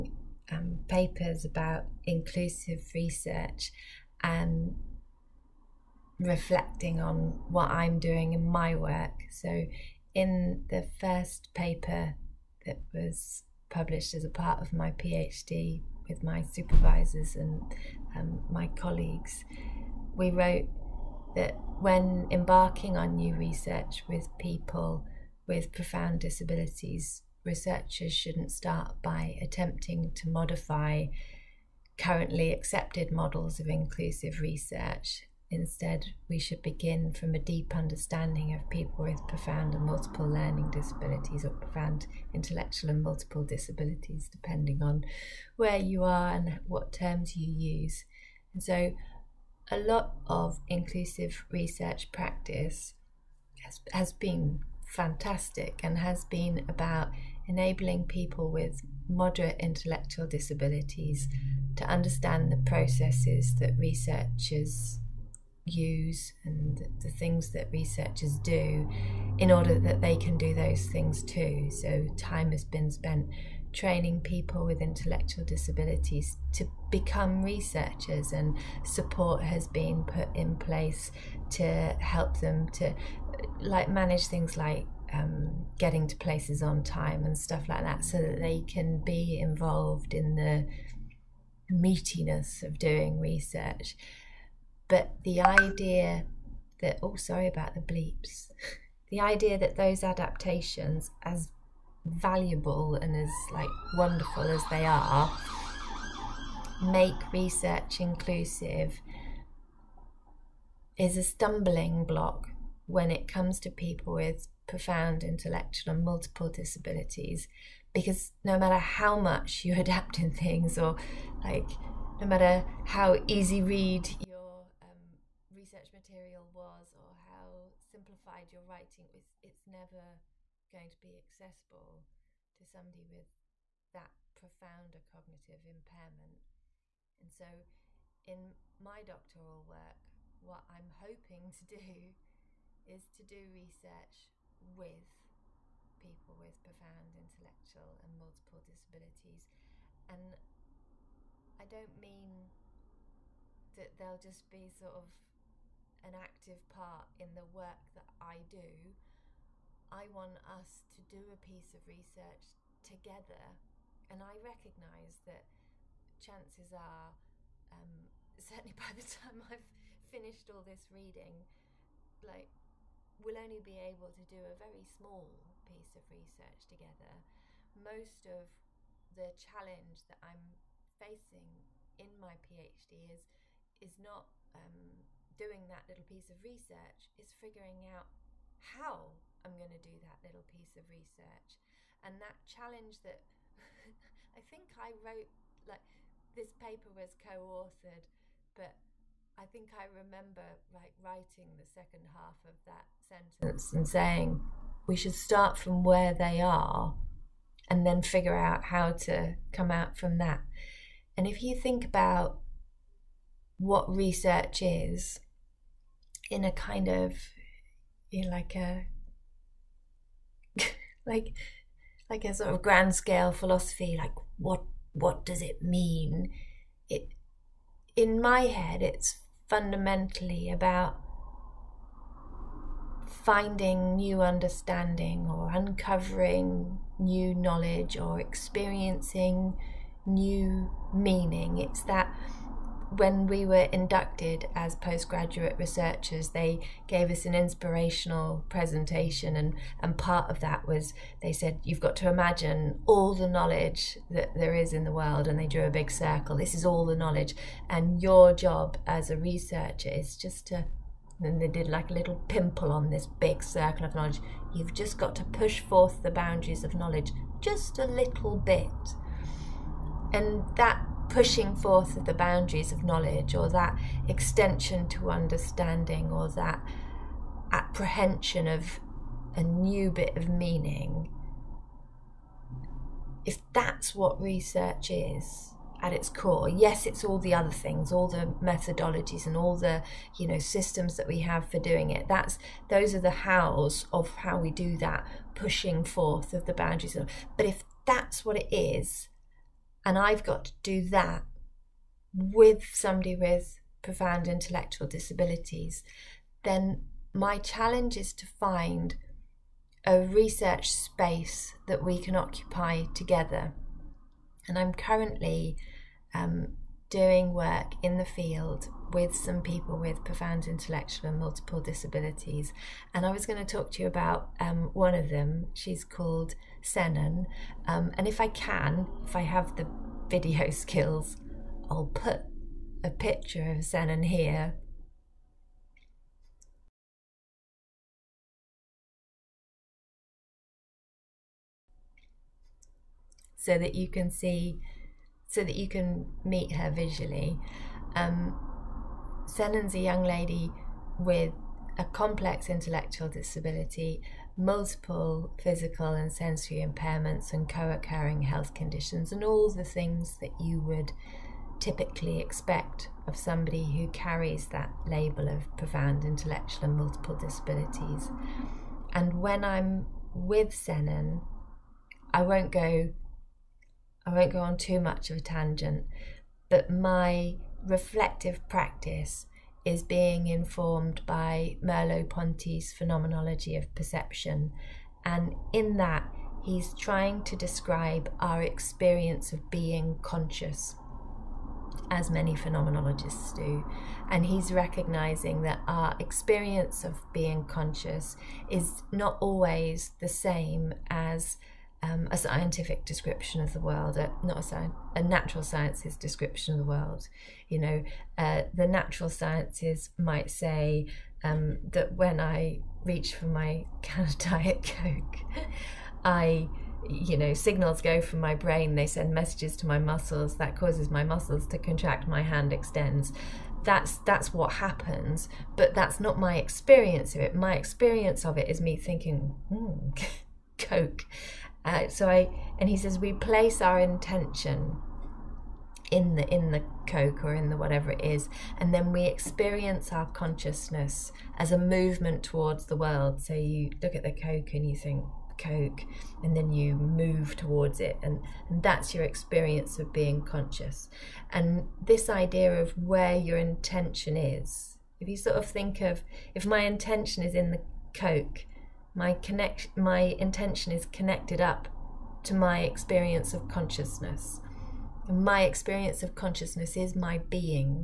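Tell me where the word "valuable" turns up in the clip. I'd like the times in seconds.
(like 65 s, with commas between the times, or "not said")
102 s.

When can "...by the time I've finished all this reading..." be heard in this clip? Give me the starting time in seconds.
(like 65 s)
168 s.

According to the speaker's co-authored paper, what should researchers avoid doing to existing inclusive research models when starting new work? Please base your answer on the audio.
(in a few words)
Modify.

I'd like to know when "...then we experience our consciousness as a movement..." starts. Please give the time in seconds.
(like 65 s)
438 s.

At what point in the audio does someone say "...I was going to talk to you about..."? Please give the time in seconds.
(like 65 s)
323 s.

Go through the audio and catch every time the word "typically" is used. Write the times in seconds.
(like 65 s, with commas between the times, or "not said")
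361 s.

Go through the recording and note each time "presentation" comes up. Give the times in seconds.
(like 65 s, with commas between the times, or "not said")
248 s.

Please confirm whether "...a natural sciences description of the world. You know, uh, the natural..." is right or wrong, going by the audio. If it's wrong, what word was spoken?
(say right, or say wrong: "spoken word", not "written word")
right.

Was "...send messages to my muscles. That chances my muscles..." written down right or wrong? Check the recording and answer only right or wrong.
wrong.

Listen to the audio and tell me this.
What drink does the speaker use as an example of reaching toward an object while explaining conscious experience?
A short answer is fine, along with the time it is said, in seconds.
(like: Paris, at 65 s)
Diet Coke, at 414 s.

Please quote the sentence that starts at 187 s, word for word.
Is figuring out how I'm going to do that little piece of research.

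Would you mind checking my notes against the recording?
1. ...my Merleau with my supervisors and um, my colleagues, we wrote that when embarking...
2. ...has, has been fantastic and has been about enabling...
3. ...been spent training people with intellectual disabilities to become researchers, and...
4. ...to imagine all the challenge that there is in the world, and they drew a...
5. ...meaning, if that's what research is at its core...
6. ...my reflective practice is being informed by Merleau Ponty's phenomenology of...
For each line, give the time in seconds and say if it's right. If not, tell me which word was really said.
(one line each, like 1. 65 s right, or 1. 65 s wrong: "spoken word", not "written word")
1. 14 s wrong: "PhD", not "Merleau"
2. 53 s right
3. 72 s right
4. 251 s wrong: "knowledge", not "challenge"
5. 280 s right
6. 376 s right.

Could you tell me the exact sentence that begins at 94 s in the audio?
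But the idea that oh, sorry about the bleeps.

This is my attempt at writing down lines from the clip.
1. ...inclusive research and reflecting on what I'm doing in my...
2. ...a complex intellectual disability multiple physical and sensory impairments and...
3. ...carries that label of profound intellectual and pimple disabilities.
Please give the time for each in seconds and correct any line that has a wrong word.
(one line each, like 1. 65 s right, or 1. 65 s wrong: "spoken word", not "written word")
1. 2 s right
2. 351 s right
3. 363 s wrong: "multiple", not "pimple".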